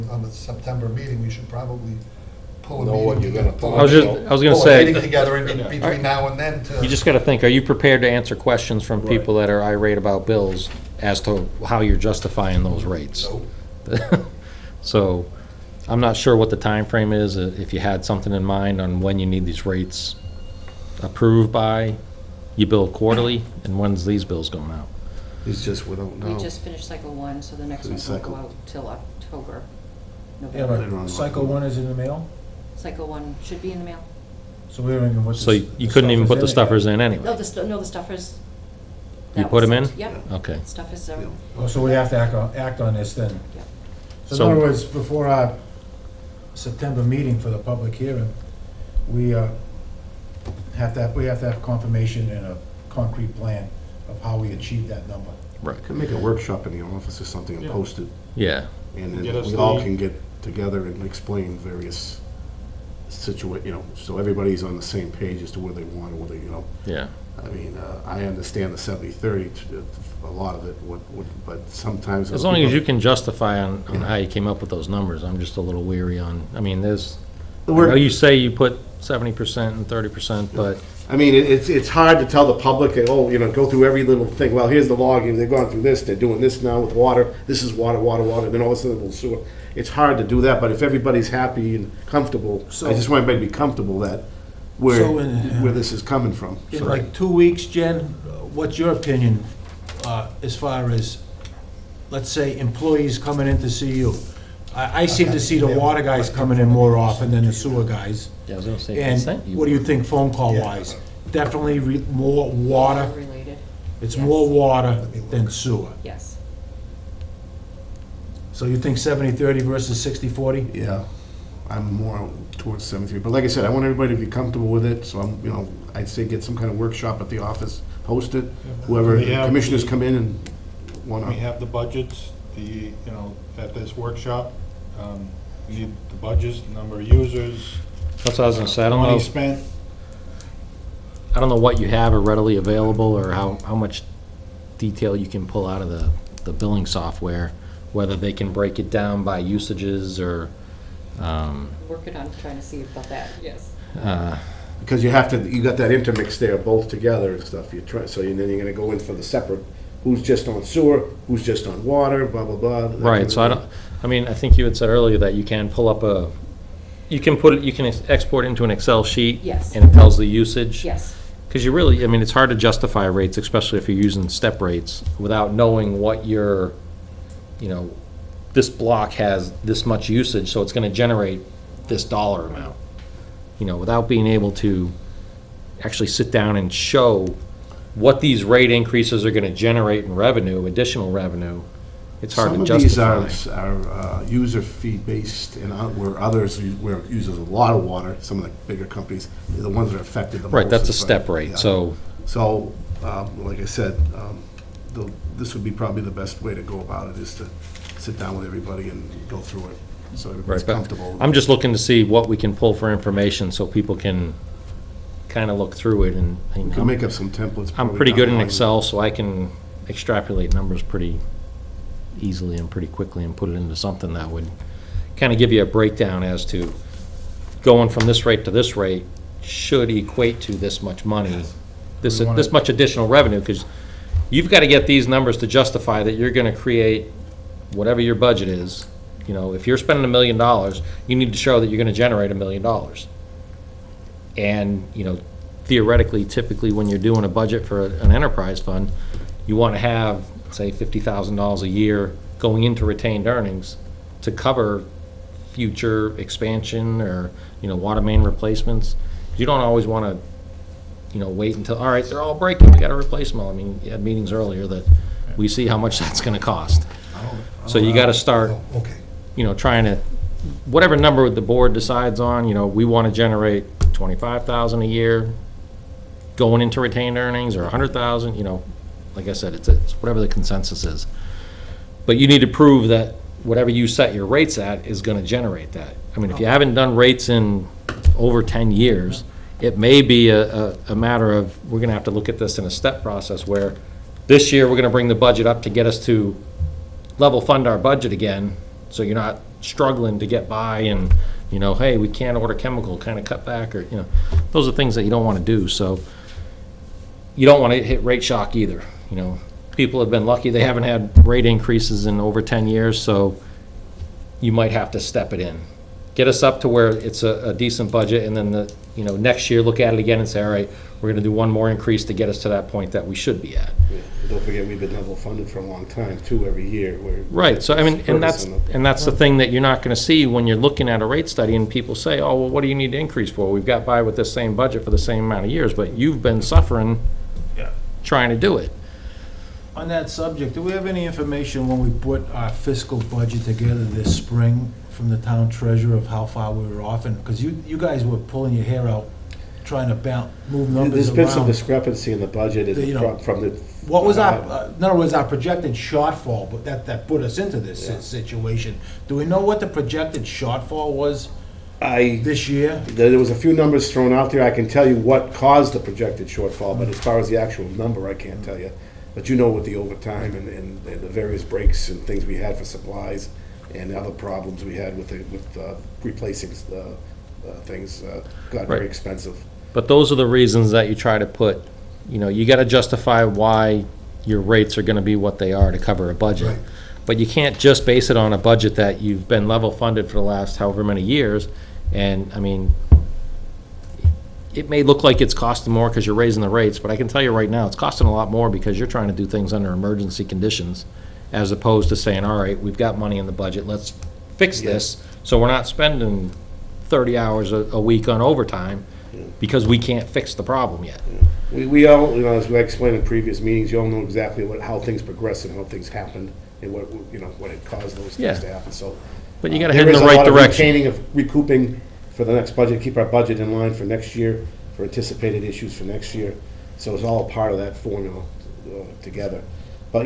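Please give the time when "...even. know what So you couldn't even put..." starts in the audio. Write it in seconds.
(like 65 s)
35 s.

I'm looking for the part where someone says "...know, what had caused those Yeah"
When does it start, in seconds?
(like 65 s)
417 s.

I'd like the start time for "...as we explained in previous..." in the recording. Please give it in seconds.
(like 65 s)
412 s.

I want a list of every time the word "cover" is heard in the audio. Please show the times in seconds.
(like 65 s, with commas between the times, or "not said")
254 s, 385 s.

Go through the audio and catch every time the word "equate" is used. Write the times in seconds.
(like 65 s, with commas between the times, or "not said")
229 s.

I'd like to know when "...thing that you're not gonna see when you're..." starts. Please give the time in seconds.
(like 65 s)
329 s.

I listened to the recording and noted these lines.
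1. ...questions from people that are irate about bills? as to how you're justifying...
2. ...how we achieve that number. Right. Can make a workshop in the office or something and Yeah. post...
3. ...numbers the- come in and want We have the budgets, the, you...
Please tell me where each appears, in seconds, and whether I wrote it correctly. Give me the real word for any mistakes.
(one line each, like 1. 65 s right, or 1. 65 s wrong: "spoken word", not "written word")
1. 8 s right
2. 54 s right
3. 129 s wrong: "commissioners", not "numbers".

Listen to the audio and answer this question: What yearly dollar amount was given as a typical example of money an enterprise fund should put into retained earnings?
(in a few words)
$50,000.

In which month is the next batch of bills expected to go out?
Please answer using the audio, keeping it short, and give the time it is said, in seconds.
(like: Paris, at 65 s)
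October, at 28 s.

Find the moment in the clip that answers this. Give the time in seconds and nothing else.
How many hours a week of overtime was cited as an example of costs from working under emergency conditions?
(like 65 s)
406 s.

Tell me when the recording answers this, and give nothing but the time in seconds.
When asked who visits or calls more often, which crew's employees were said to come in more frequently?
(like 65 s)
105 s.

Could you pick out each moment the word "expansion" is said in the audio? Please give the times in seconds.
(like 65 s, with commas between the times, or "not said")
256 s.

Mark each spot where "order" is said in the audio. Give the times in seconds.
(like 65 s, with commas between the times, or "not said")
302 s.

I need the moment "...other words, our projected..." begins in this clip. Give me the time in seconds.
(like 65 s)
354 s.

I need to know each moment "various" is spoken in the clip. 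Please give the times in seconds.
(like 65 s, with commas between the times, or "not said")
61 s, 371 s.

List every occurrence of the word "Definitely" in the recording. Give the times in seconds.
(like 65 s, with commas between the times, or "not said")
111 s.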